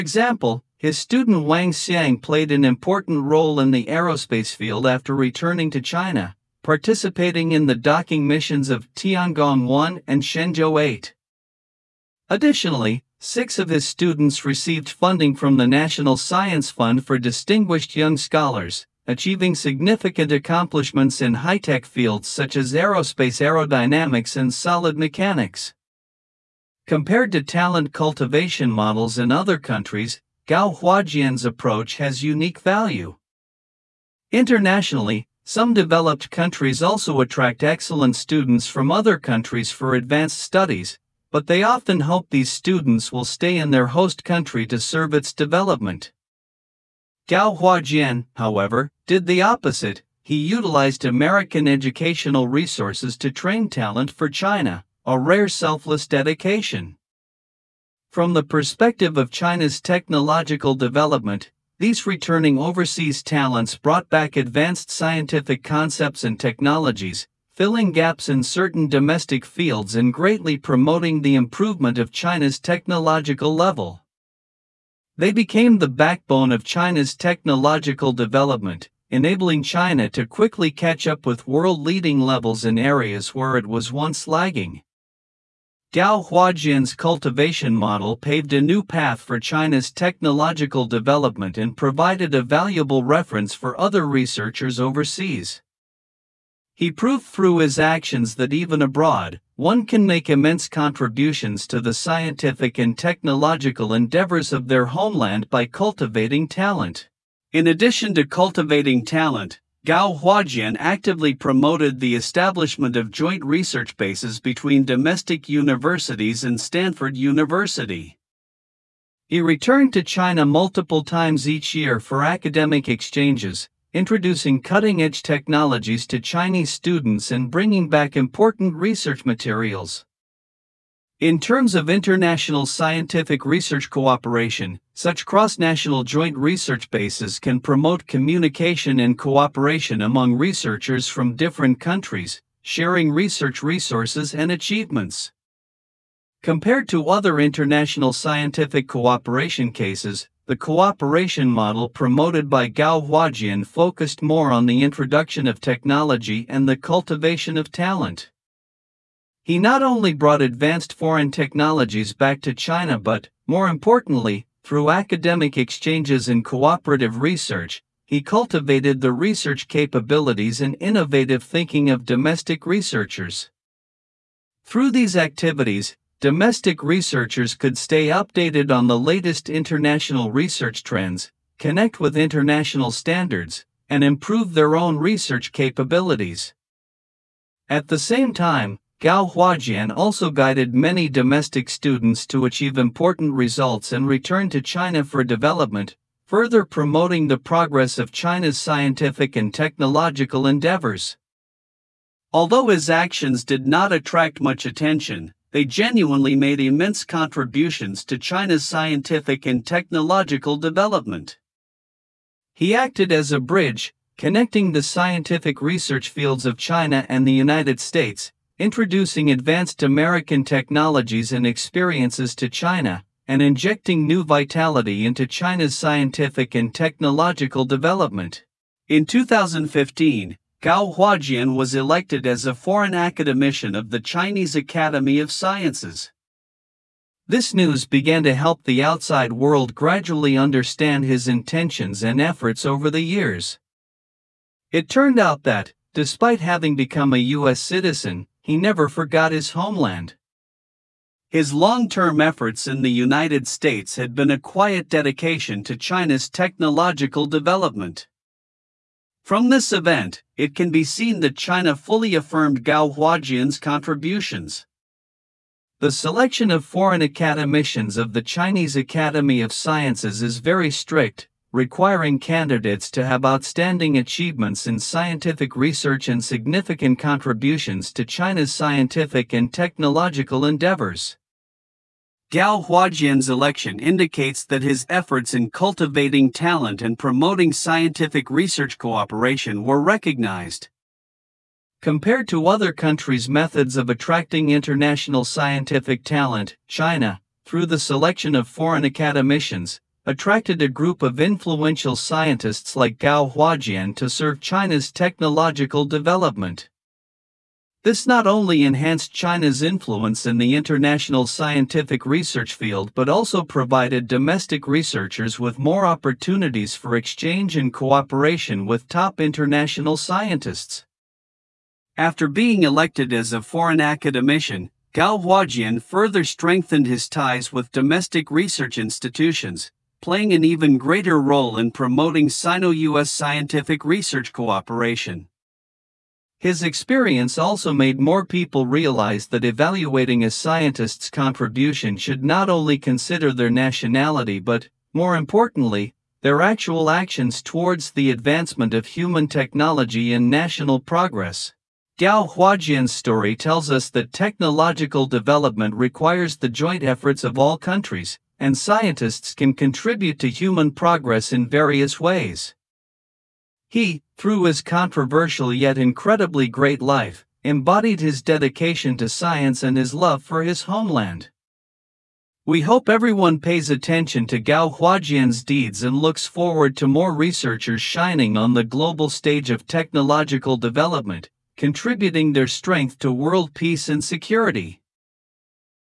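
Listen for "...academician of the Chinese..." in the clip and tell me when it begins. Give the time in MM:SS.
03:52.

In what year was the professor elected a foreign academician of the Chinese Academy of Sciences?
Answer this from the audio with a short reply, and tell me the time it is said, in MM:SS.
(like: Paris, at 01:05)
2015, at 03:49.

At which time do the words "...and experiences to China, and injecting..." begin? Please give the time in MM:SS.
03:41.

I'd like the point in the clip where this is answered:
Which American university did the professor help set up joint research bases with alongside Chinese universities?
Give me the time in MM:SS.
01:56.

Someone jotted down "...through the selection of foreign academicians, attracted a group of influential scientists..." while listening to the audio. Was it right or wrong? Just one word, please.
right.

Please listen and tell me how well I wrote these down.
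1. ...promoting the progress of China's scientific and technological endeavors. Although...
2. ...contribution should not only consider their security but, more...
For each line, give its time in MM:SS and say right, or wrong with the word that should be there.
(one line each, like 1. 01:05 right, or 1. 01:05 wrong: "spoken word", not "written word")
1. 03:16 right
2. 05:41 wrong: "nationality", not "security".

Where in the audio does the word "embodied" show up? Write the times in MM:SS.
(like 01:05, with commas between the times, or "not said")
06:07.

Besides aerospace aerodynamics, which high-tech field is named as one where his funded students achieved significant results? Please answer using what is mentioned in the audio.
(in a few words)
solid mechanics.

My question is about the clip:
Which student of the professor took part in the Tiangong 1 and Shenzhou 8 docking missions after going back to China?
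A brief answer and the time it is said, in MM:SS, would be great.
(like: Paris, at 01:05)
Wang Xiang, at 00:01.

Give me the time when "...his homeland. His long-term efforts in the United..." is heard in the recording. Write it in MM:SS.
04:09.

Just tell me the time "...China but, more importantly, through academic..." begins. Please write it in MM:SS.
02:42.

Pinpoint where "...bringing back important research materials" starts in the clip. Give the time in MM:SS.
02:07.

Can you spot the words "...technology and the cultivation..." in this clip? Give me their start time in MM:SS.
02:35.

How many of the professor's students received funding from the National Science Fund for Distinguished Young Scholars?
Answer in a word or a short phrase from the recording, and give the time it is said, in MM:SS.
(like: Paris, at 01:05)
6, at 00:13.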